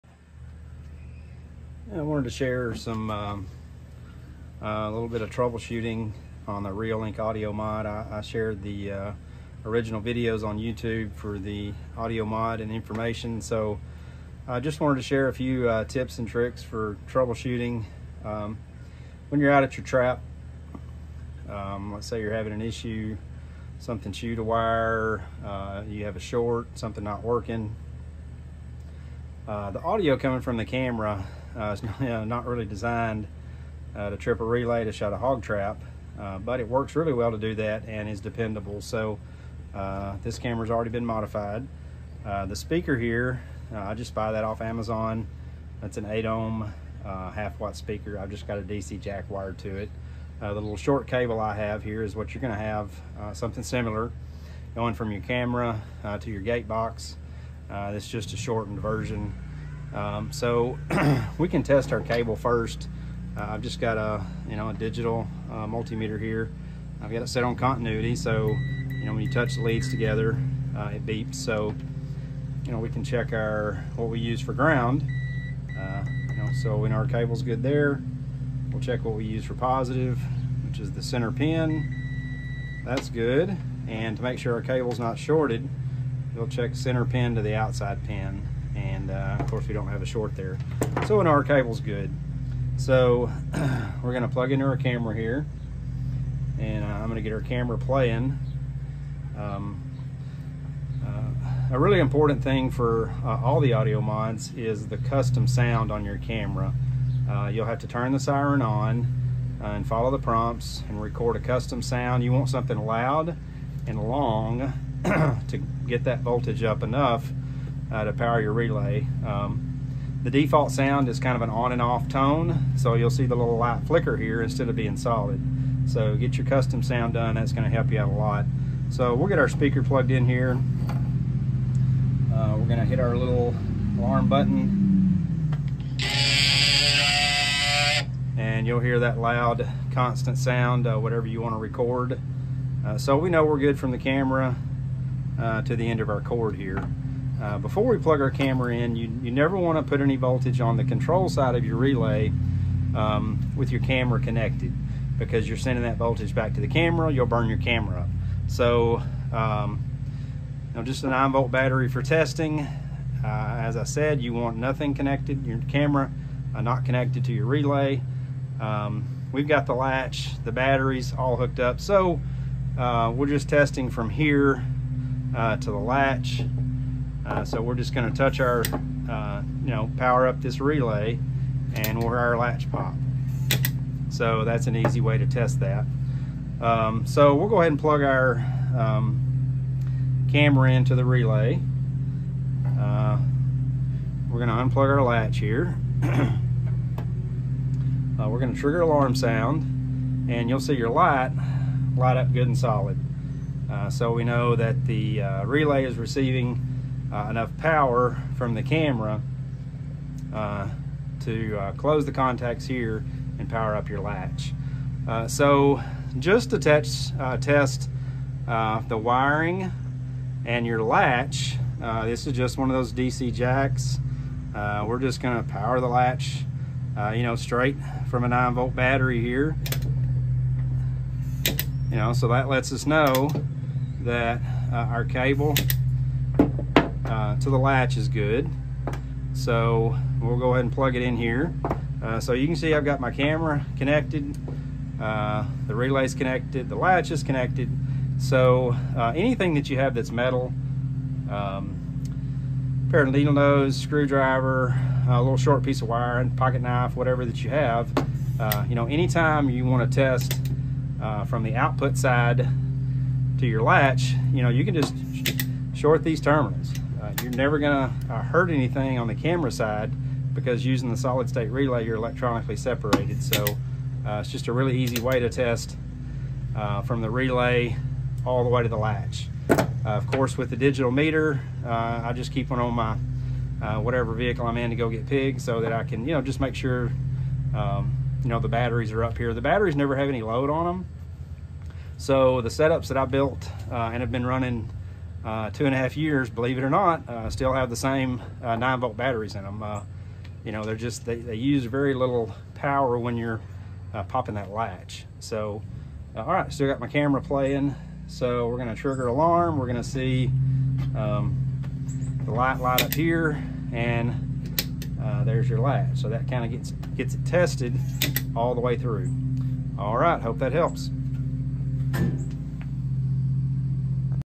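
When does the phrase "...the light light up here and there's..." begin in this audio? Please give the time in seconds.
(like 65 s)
312 s.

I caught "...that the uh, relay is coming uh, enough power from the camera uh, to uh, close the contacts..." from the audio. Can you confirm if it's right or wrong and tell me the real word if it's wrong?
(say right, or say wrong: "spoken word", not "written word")
wrong: "receiving", not "coming".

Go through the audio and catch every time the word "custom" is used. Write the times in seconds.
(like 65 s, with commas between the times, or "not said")
104 s, 111 s, 126 s.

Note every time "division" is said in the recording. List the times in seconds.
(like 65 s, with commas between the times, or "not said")
not said.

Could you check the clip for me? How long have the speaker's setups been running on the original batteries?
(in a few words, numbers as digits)
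two and a half years.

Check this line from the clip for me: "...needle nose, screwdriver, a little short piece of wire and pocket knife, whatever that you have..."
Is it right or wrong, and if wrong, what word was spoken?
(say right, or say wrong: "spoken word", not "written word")
right.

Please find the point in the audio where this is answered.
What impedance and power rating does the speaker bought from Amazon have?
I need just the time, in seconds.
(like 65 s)
46 s.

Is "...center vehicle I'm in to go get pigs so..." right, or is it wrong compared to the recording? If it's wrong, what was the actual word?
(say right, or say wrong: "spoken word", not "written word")
wrong: "whatever", not "center".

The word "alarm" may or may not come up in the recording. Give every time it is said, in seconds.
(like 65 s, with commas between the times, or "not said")
133 s, 198 s, 309 s.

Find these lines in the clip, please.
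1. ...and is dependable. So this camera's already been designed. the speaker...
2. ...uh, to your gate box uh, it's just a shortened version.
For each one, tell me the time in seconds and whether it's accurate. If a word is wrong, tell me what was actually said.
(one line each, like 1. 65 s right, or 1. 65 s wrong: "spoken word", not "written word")
1. 37 s wrong: "modified", not "designed"
2. 56 s right.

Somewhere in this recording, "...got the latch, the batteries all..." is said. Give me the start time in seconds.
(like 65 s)
169 s.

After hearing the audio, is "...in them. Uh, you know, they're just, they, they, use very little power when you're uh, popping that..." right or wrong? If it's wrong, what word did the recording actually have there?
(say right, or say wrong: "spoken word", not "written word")
right.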